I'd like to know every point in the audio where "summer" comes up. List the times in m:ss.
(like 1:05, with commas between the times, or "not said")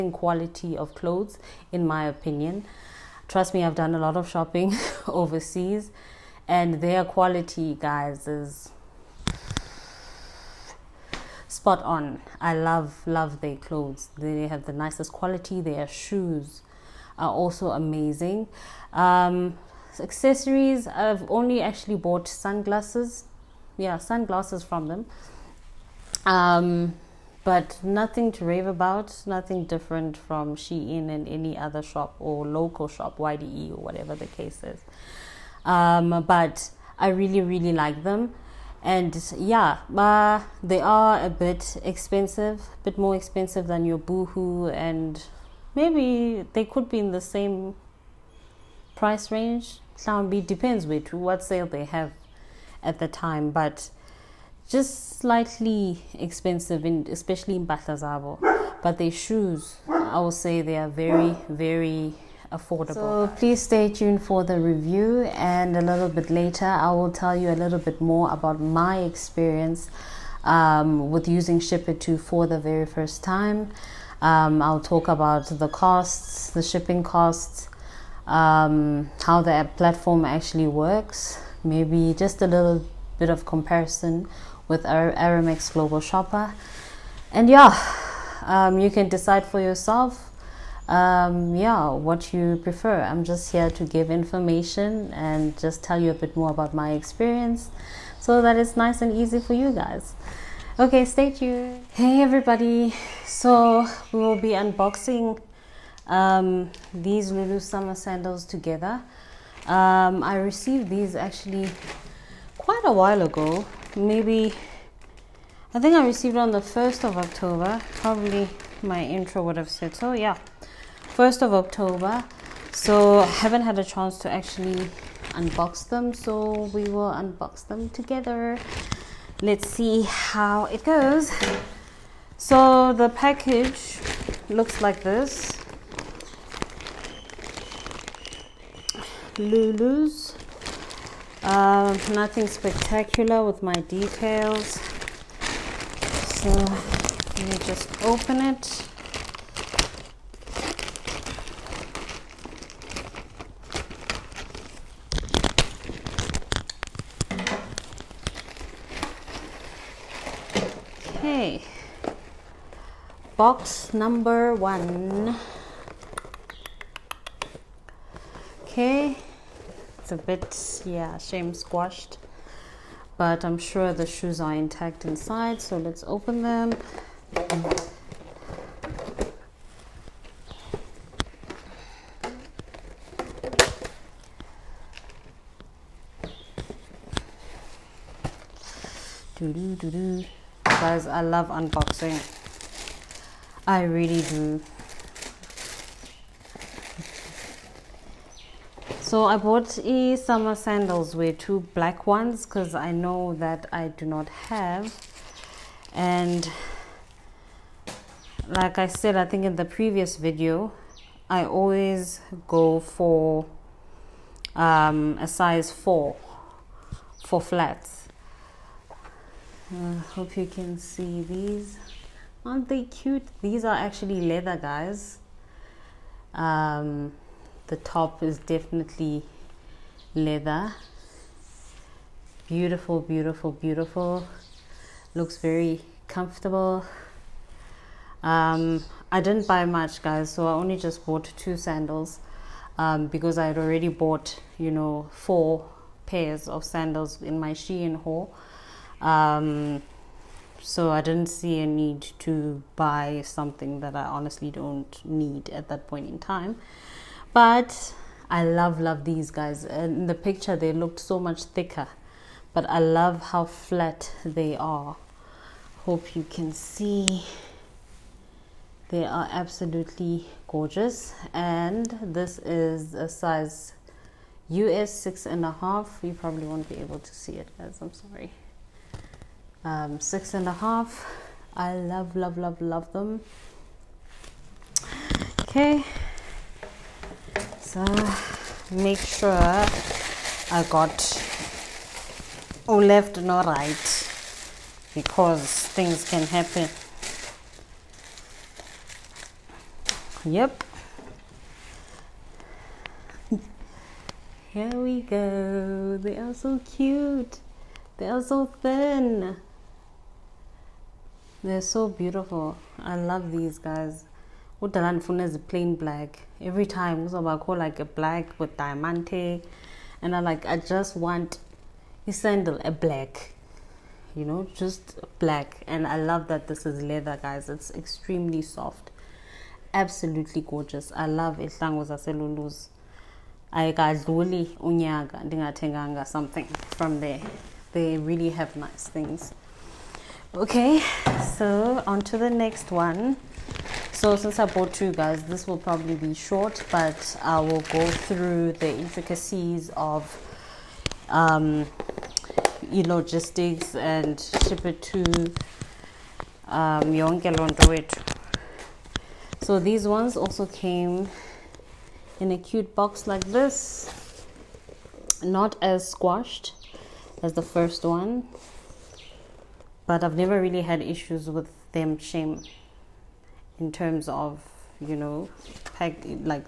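1:47, 3:20.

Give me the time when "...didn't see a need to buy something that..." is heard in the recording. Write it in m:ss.
4:11.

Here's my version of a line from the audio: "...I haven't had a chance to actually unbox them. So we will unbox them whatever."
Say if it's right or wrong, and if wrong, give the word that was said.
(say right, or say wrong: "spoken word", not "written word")
wrong: "together", not "whatever".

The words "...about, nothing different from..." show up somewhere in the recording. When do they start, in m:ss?
0:28.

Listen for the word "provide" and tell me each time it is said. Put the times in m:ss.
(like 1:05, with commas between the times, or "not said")
not said.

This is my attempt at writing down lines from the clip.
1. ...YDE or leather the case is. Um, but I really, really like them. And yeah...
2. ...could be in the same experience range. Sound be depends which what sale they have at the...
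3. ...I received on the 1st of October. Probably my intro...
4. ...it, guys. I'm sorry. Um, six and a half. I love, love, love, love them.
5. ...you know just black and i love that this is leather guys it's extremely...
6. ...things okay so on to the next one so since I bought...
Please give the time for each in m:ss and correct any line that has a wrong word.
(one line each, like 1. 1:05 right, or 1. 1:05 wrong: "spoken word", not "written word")
1. 0:33 wrong: "whatever", not "leather"
2. 0:46 wrong: "price", not "experience"
3. 1:55 right
4. 4:37 right
5. 5:24 right
6. 5:38 right.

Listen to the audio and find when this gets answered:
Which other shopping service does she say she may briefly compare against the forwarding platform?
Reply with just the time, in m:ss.
1:24.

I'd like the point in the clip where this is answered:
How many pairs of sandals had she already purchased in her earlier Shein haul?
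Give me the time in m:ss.
4:05.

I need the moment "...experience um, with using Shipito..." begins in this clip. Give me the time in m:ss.
1:09.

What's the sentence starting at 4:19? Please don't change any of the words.
In the picture, they looked so much thicker, but I love how flat they are.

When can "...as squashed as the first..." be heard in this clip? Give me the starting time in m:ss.
6:05.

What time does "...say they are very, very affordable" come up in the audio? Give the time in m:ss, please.
1:00.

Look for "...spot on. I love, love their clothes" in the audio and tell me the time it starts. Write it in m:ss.
0:11.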